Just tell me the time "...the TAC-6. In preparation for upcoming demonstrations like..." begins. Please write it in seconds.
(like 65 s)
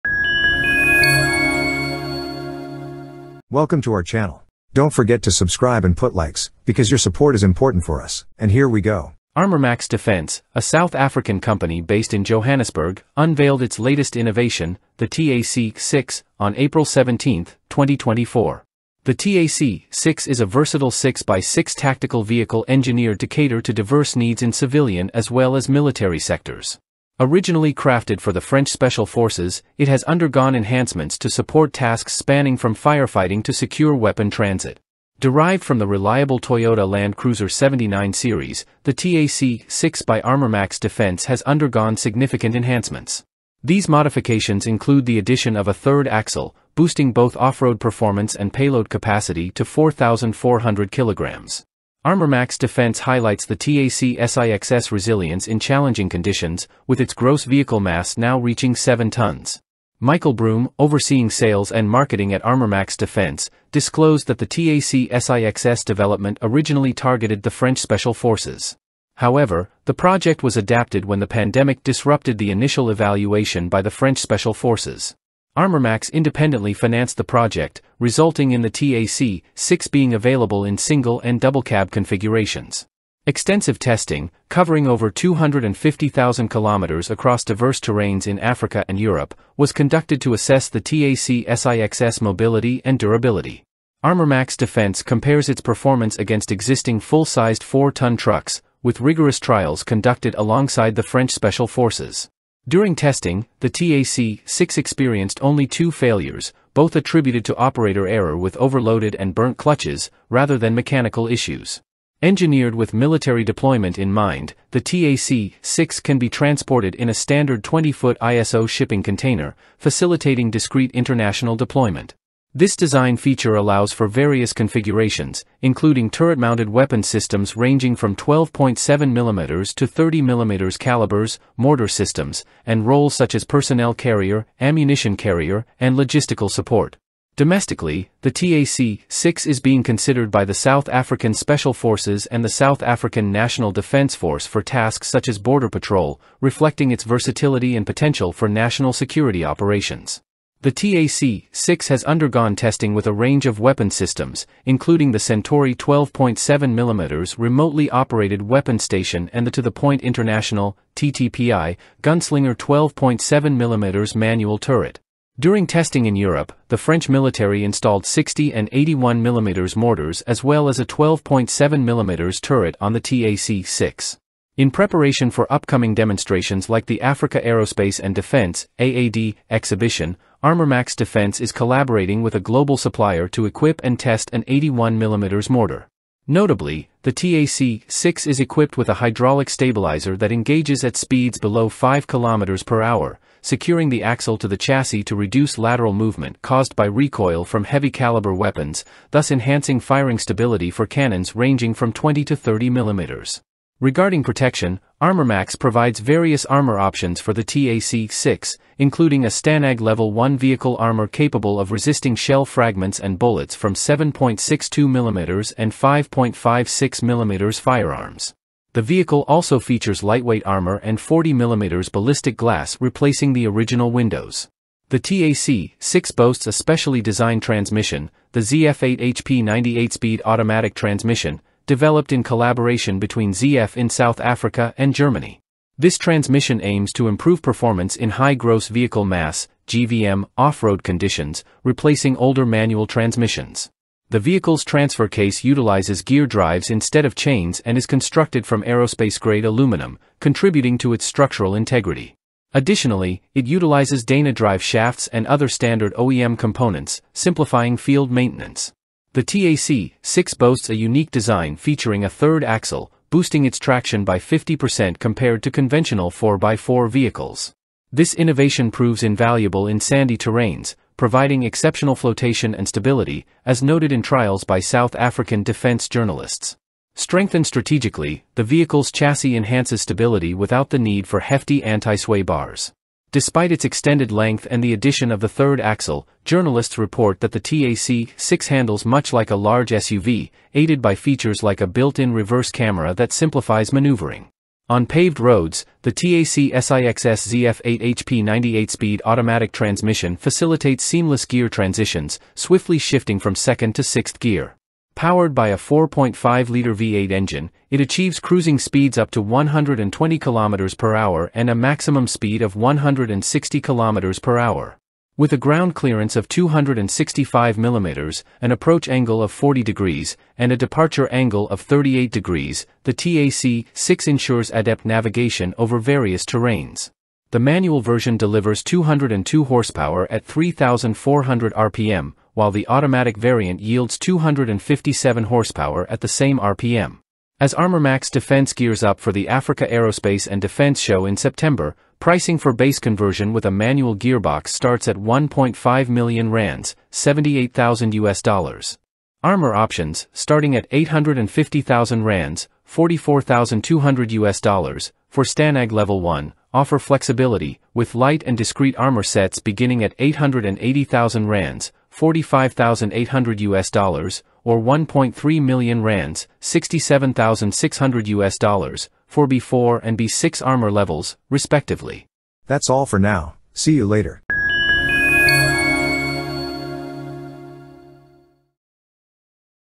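172 s.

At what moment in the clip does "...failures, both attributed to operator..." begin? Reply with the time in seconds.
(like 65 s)
105 s.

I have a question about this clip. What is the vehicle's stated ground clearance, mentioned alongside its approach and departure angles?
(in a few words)
265 mm.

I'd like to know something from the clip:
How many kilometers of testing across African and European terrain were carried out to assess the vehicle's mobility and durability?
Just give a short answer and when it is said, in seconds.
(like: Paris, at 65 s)
250,000 kilometers, at 85 s.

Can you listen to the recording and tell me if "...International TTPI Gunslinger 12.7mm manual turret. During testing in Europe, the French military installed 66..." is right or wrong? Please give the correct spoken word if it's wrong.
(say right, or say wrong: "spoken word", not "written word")
wrong: "60", not "66".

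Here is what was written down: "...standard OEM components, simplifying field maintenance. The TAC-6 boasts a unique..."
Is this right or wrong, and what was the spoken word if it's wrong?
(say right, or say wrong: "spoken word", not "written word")
right.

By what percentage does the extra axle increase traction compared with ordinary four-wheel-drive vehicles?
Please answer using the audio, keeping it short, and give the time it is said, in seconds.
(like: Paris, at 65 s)
50%, at 264 s.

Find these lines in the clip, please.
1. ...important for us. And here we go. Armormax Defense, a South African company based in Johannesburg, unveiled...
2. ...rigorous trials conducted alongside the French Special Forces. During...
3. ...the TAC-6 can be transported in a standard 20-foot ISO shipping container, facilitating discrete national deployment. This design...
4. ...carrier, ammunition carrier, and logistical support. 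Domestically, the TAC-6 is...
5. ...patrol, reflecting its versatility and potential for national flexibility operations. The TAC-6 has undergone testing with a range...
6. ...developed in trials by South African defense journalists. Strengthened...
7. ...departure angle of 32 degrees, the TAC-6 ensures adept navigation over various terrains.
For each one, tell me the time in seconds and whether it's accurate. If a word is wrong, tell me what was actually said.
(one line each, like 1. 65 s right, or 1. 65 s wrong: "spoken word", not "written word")
1. 7 s right
2. 99 s right
3. 114 s wrong: "international", not "national"
4. 133 s right
5. 145 s wrong: "security", not "flexibility"
6. 273 s wrong: "noted", not "developed"
7. 320 s wrong: "38", not "32".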